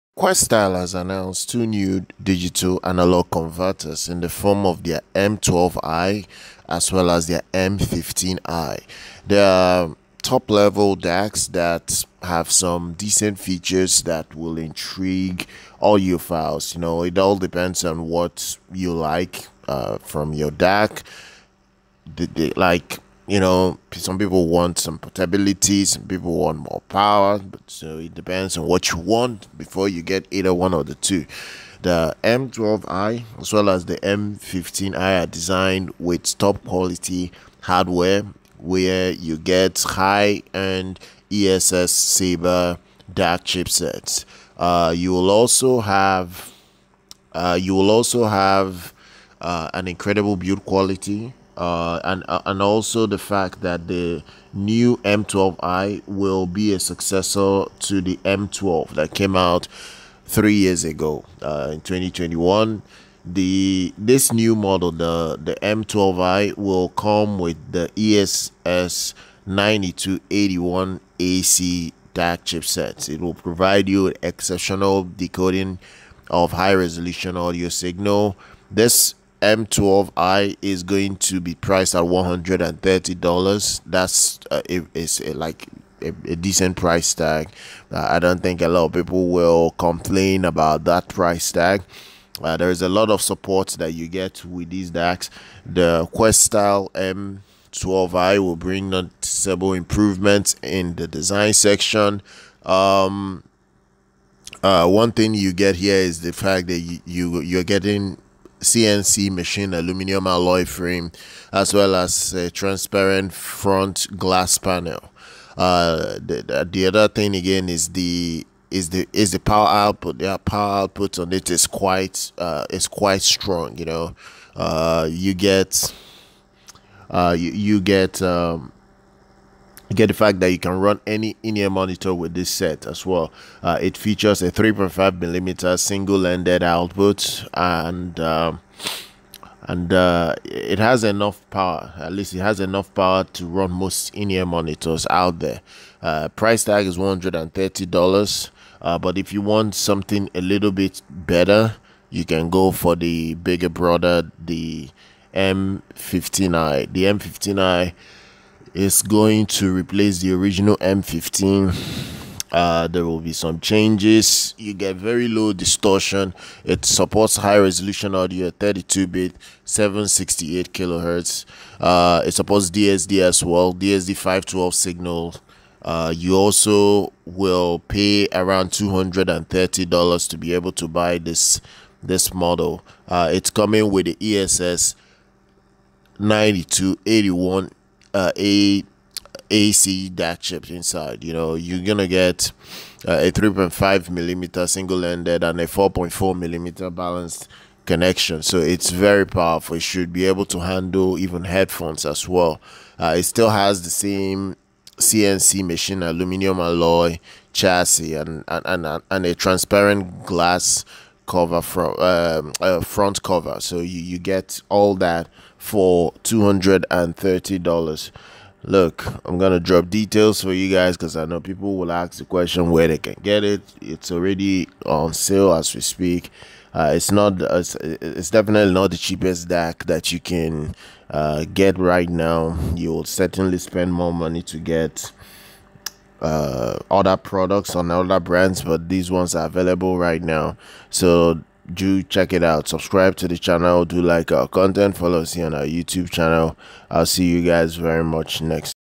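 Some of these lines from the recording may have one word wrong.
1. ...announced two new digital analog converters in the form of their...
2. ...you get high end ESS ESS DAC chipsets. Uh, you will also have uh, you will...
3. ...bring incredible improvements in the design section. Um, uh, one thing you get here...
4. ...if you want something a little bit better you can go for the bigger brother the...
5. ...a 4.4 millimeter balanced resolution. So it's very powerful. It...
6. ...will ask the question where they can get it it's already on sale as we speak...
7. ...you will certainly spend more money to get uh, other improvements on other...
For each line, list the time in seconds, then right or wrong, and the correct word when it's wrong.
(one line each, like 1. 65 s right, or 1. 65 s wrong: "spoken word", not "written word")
1. 0 s right
2. 39 s wrong: "Sabre", not "ESS"
3. 98 s wrong: "noticeable", not "incredible"
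4. 149 s right
5. 195 s wrong: "connection", not "resolution"
6. 221 s right
7. 232 s wrong: "products", not "improvements".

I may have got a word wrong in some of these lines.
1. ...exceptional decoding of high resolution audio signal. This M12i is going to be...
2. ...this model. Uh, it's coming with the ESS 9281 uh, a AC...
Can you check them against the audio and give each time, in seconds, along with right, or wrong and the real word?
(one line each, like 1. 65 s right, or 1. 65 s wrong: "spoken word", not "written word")
1. 74 s right
2. 182 s right.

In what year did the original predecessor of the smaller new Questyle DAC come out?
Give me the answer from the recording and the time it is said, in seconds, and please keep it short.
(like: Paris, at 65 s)
2021, at 61 s.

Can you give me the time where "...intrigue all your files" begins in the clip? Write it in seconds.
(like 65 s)
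14 s.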